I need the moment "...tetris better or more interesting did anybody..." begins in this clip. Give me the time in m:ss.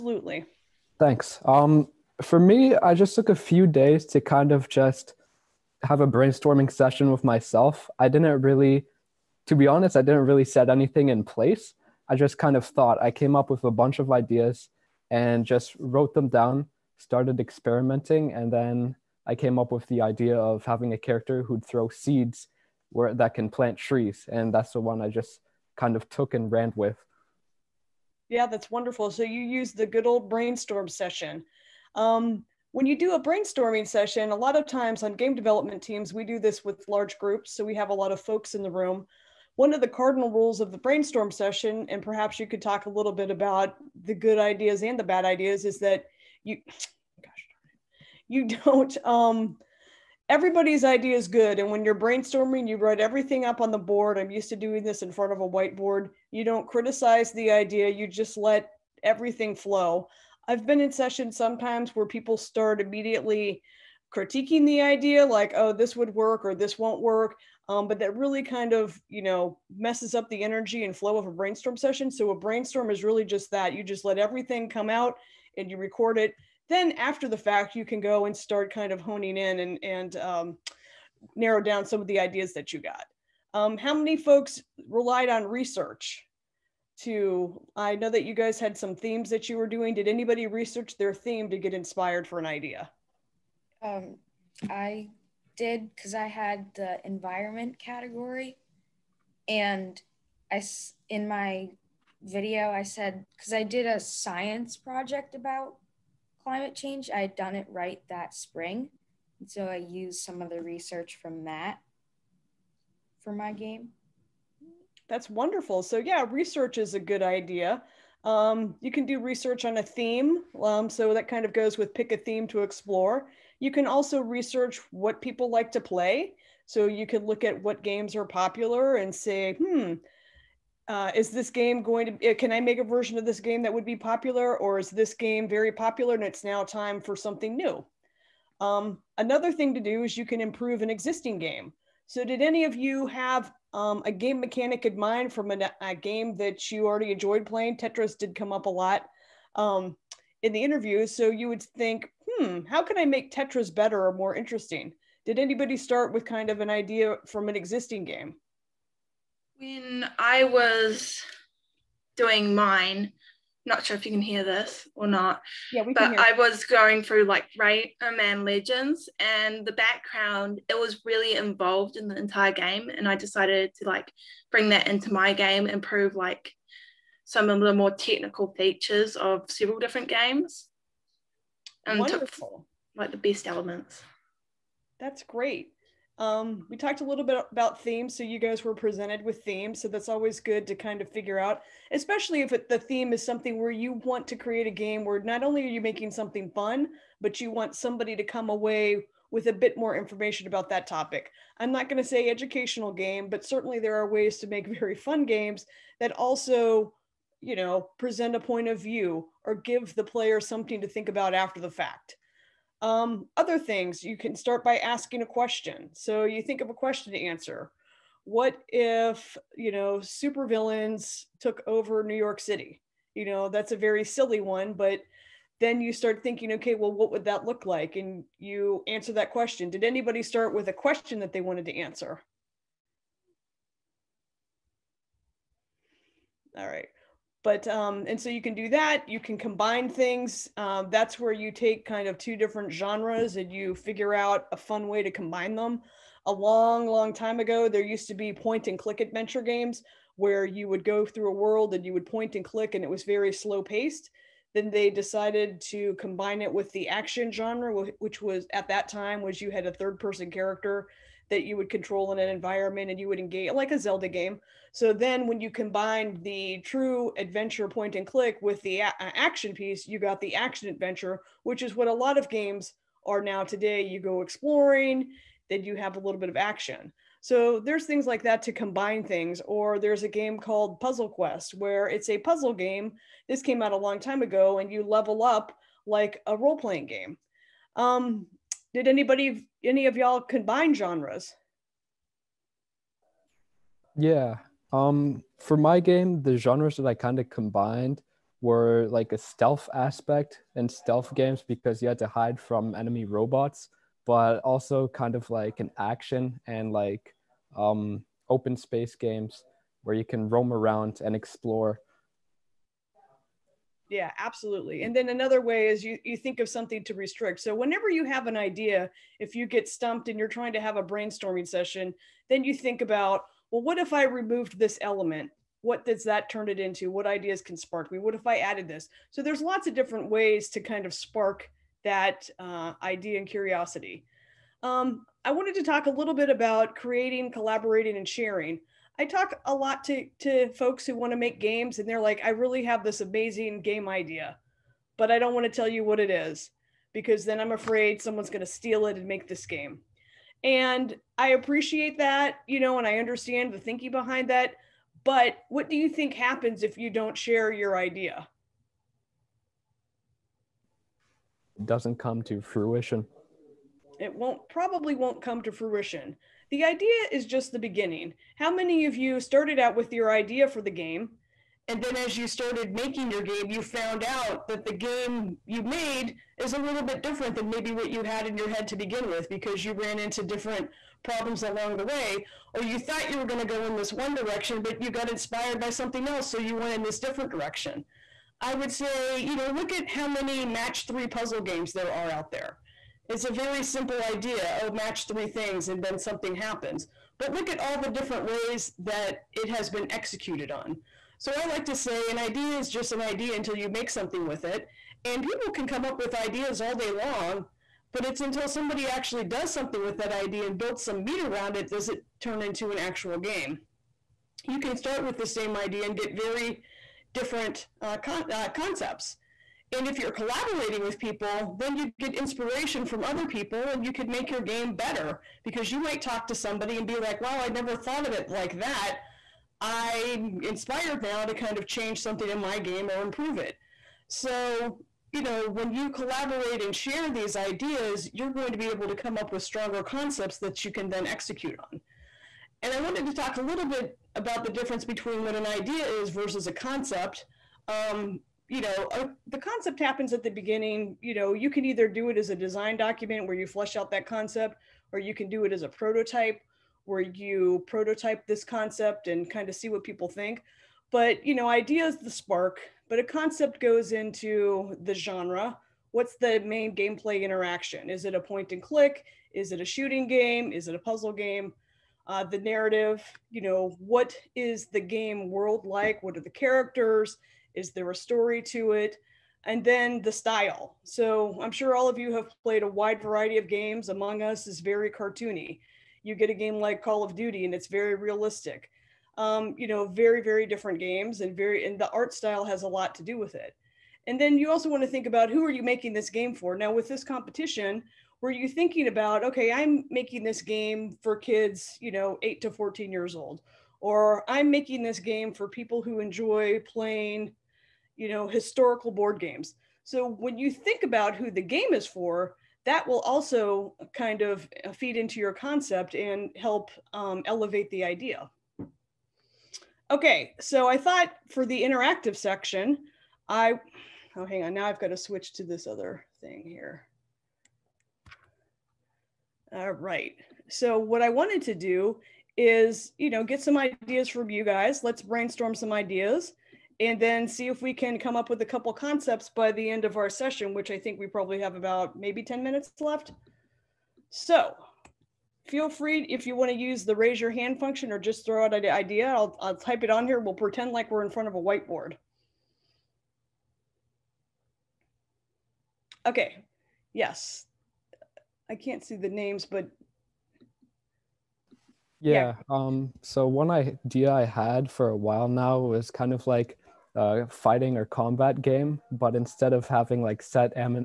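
2:33.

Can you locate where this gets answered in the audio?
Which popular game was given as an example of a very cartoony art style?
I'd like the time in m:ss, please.
8:03.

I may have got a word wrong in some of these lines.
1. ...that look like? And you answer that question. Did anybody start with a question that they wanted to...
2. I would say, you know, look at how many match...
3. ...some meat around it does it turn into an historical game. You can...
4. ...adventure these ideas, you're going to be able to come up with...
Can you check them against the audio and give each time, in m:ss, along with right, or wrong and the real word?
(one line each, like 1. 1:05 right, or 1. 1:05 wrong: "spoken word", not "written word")
1. 3:47 right
2. 6:28 right
3. 6:50 wrong: "actual", not "historical"
4. 7:16 wrong: "share", not "adventure".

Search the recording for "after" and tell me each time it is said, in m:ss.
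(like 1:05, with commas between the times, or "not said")
1:16, 3:31.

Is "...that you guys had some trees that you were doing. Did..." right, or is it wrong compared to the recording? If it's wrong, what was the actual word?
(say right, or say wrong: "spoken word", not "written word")
wrong: "themes", not "trees".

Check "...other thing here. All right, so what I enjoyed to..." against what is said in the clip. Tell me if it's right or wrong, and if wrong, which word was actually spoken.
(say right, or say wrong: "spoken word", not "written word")
wrong: "wanted", not "enjoyed".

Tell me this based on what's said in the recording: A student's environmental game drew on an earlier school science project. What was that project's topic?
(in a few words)
Climate change.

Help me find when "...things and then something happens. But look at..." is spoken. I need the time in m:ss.
6:35.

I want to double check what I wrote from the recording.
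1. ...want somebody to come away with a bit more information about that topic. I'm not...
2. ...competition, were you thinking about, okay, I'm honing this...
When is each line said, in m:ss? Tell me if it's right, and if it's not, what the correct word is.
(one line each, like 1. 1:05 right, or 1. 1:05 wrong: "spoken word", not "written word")
1. 3:17 right
2. 8:17 wrong: "making", not "honing".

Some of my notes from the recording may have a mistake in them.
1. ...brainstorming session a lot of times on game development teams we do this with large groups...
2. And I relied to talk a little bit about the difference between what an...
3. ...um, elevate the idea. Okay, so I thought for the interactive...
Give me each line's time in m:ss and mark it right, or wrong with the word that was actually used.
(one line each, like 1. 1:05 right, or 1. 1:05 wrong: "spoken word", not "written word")
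1. 0:33 right
2. 7:22 wrong: "wanted", not "relied"
3. 8:36 right.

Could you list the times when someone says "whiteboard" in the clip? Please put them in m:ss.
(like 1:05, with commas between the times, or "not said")
0:55, 9:11.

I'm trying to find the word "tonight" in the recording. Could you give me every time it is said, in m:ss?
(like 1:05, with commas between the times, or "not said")
not said.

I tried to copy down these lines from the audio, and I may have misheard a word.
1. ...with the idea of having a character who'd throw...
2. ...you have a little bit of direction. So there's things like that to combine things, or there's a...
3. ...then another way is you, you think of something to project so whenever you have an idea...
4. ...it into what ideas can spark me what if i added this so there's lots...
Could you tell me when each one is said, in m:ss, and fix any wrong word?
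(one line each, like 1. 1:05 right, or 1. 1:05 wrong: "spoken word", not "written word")
1. 0:19 right
2. 4:35 wrong: "action", not "direction"
3. 5:14 wrong: "restrict", not "project"
4. 5:26 right.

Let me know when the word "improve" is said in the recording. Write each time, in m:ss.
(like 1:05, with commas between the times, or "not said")
2:20, 2:55, 7:13.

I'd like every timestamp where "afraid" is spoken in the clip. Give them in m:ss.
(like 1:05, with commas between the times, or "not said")
5:47.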